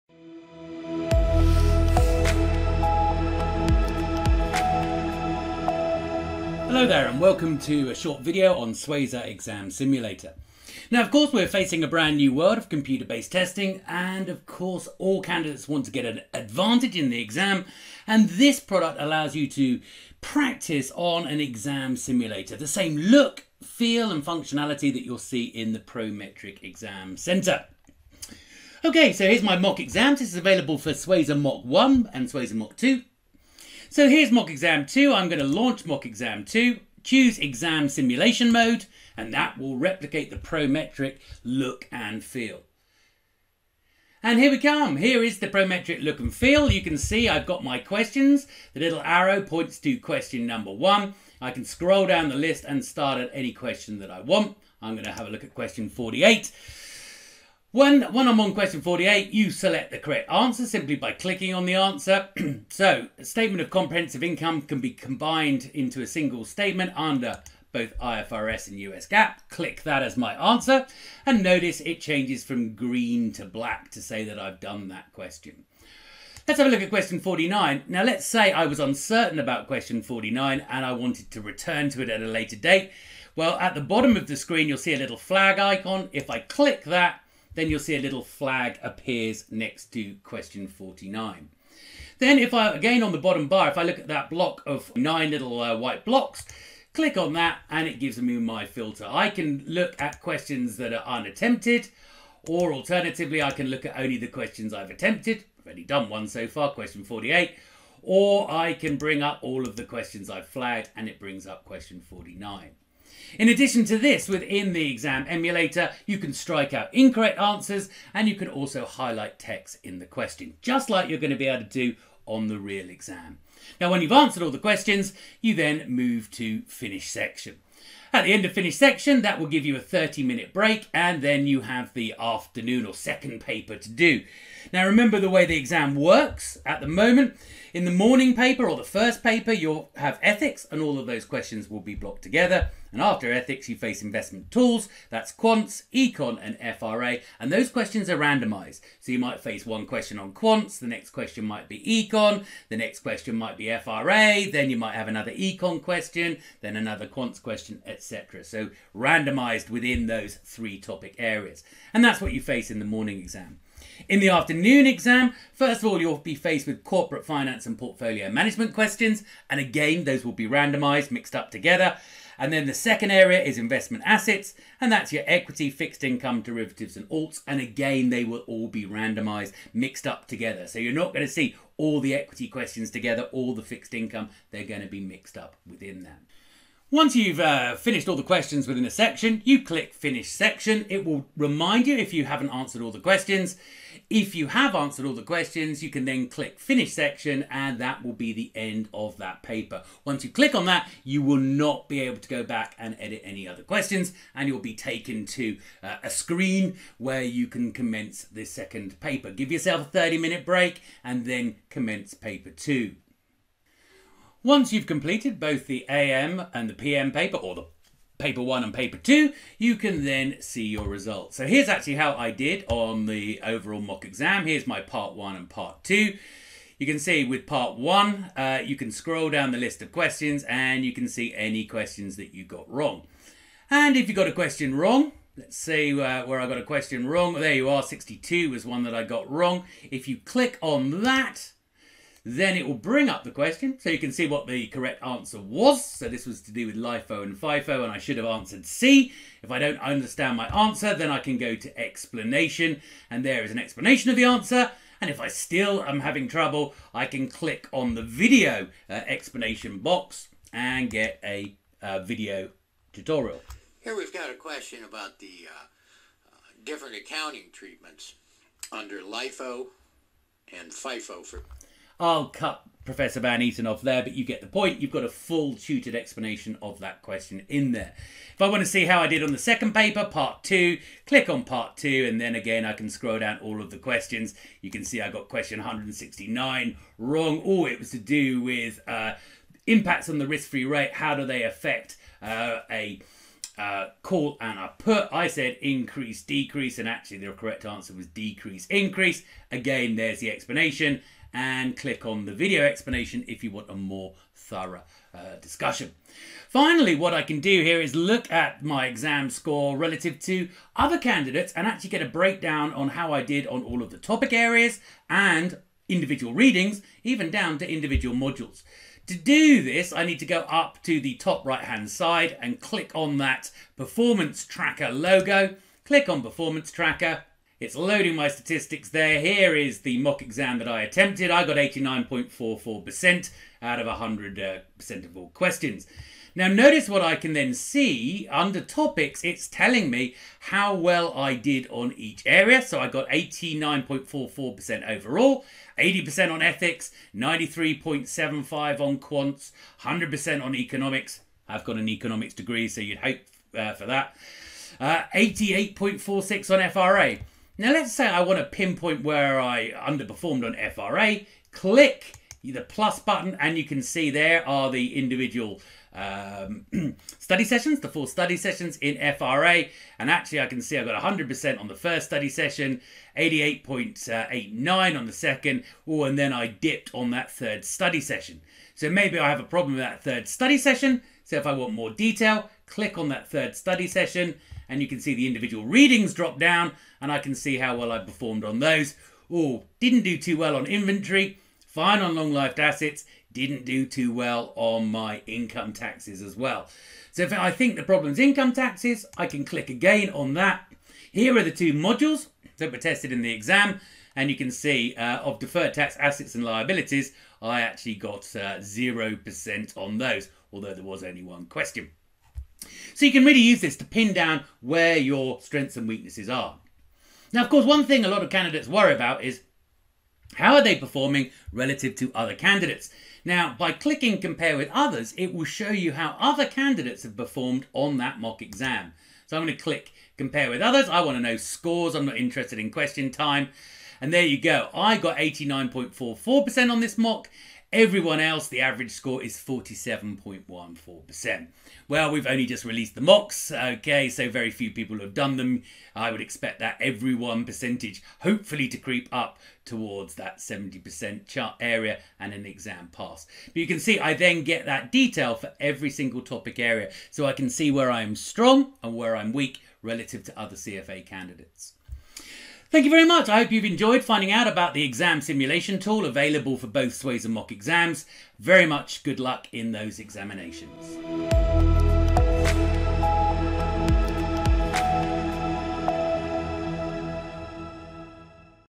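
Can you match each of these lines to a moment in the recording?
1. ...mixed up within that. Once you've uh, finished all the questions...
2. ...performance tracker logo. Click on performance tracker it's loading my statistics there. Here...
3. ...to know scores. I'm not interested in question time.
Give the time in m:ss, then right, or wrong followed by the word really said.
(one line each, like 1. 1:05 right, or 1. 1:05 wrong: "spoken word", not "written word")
1. 3:05 right
2. 5:23 right
3. 7:11 right.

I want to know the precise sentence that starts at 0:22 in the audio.
The same look, feel and functionality that you'll see in the Prometric Exam Centre.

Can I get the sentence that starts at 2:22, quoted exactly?
And after ethics, you face investment tools, that's quants, econ and FRA.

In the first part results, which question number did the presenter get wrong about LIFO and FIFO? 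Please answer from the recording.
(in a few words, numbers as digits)
62.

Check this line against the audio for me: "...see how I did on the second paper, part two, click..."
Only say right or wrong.
right.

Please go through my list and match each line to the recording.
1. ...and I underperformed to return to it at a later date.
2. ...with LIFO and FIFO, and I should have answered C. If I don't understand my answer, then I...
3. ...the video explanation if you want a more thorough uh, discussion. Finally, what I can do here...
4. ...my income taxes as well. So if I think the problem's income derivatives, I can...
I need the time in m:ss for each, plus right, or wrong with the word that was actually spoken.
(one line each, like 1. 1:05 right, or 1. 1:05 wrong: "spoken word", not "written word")
1. 1:20 wrong: "wanted", not "underperformed"
2. 4:06 right
3. 5:02 right
4. 6:34 wrong: "taxes", not "derivatives".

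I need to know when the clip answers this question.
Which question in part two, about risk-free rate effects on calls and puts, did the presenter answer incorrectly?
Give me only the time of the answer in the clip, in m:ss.
4:45.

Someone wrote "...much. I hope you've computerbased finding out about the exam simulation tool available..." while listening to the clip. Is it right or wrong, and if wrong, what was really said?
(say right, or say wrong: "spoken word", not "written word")
wrong: "enjoyed", not "computerbased".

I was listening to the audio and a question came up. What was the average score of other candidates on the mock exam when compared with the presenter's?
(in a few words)
47.14%.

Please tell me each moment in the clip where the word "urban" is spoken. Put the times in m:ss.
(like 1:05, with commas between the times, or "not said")
not said.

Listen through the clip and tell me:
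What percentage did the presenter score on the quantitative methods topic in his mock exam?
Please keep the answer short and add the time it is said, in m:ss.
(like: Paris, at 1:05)
93.75%, at 5:47.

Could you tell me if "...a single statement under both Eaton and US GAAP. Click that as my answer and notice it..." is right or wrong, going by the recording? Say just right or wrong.
wrong.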